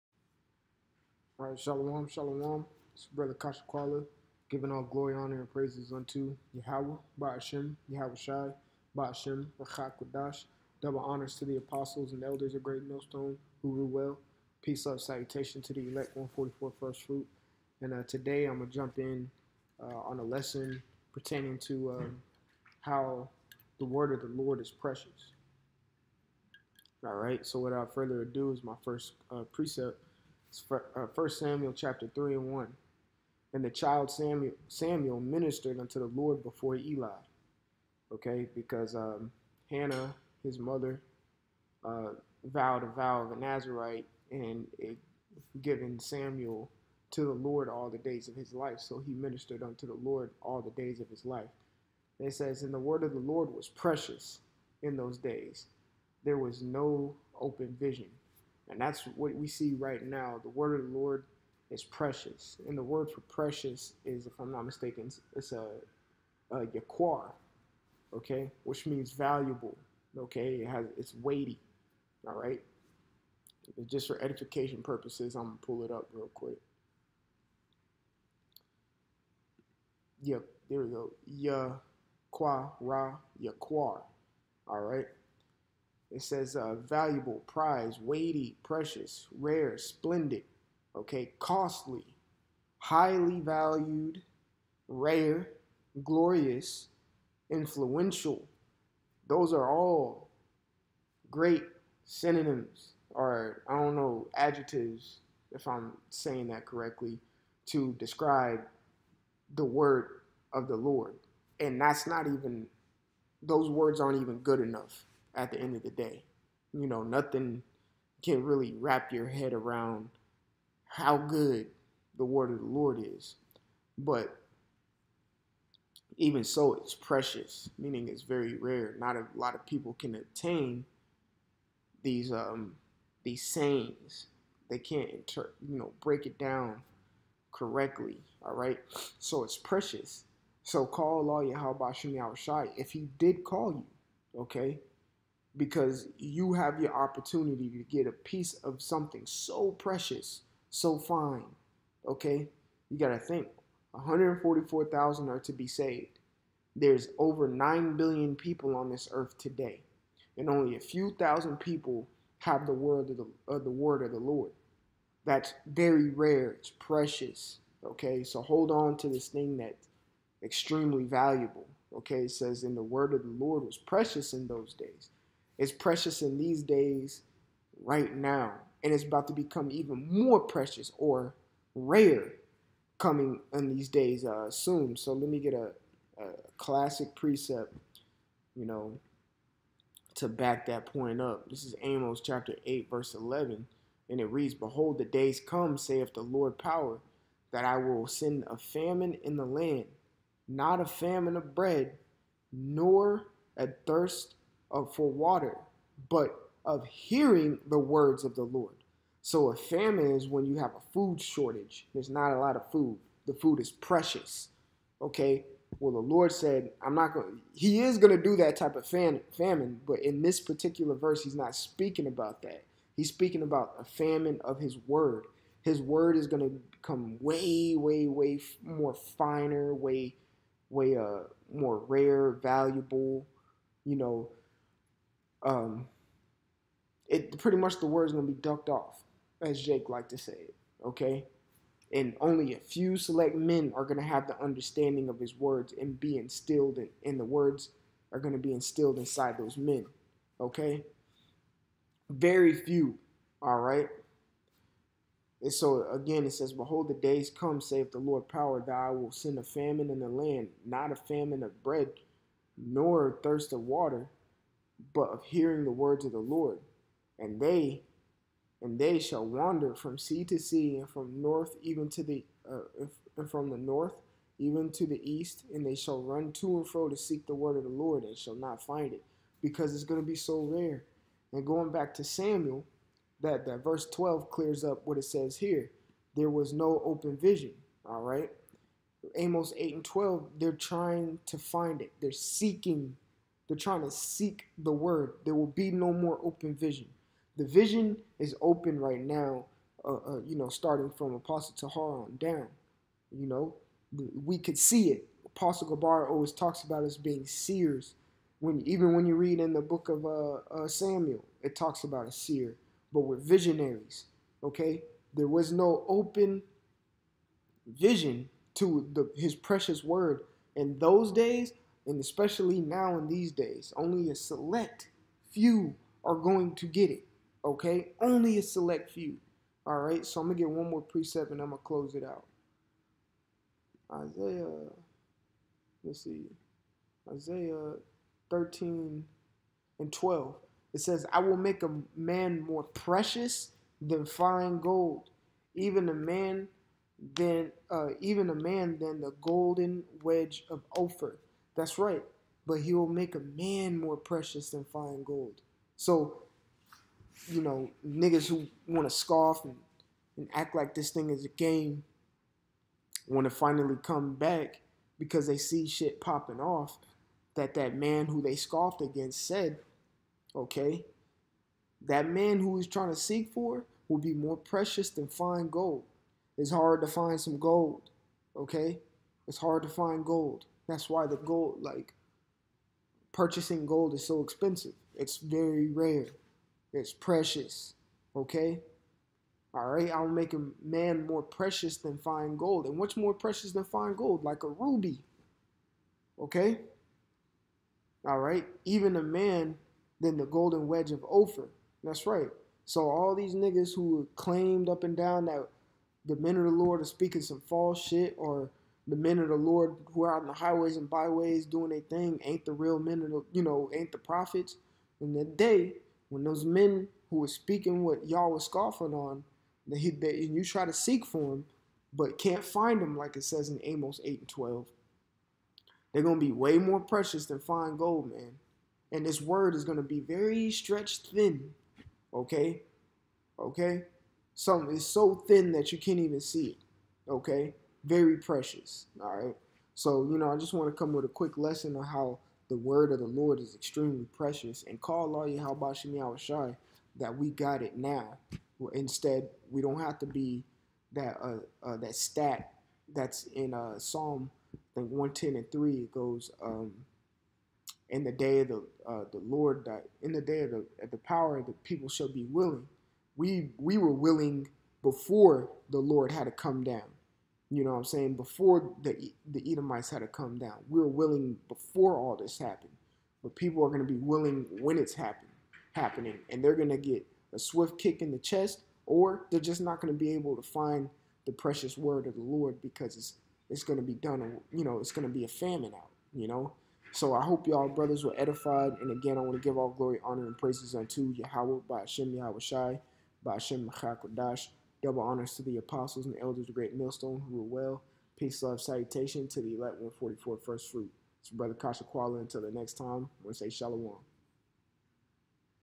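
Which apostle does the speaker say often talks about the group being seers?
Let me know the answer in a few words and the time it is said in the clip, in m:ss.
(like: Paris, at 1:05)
Apostle Gabar, at 5:05.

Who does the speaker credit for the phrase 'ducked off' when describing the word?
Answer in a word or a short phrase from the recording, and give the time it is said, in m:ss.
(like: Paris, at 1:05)
Jake, at 3:59.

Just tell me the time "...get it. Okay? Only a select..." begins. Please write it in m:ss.
5:26.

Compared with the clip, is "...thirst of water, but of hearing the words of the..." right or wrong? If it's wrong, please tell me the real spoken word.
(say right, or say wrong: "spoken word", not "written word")
right.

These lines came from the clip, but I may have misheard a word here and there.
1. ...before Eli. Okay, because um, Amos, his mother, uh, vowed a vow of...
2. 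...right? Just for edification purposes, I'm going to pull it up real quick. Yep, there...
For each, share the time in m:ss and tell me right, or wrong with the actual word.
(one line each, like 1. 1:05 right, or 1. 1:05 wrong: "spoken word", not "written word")
1. 0:36 wrong: "Hannah", not "Amos"
2. 1:12 right.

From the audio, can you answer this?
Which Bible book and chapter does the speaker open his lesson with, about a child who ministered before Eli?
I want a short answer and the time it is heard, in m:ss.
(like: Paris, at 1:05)
1 Samuel chapter 3, at 0:31.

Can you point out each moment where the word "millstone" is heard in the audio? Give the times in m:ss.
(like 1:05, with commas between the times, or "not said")
0:12, 8:16.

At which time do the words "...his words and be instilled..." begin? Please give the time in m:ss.
4:05.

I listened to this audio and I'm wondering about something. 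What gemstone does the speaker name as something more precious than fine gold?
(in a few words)
ruby.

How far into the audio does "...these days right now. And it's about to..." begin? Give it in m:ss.
2:56.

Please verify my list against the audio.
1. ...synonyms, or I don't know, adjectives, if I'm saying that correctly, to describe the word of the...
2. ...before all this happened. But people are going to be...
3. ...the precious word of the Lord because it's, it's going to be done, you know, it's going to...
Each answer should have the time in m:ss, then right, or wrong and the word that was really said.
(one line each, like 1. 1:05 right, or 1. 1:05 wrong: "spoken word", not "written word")
1. 1:42 right
2. 7:51 right
3. 8:01 right.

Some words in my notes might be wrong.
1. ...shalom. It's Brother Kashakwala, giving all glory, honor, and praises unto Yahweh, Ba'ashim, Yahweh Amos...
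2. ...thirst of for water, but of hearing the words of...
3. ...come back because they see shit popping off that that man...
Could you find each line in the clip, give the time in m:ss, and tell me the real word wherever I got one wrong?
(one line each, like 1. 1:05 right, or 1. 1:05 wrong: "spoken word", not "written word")
1. 0:02 wrong: "Shai", not "Amos"
2. 3:23 right
3. 6:03 right.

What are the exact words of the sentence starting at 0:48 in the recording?
So he ministered unto the Lord all the days of his life.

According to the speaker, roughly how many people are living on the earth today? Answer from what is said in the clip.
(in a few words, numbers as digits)
over 9 billion.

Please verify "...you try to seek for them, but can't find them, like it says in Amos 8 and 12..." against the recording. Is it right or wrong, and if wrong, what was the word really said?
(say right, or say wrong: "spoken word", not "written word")
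right.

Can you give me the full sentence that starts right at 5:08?
When even when you read in the book of uh, uh, Samuel, it talks about a seer, but we're visionaries.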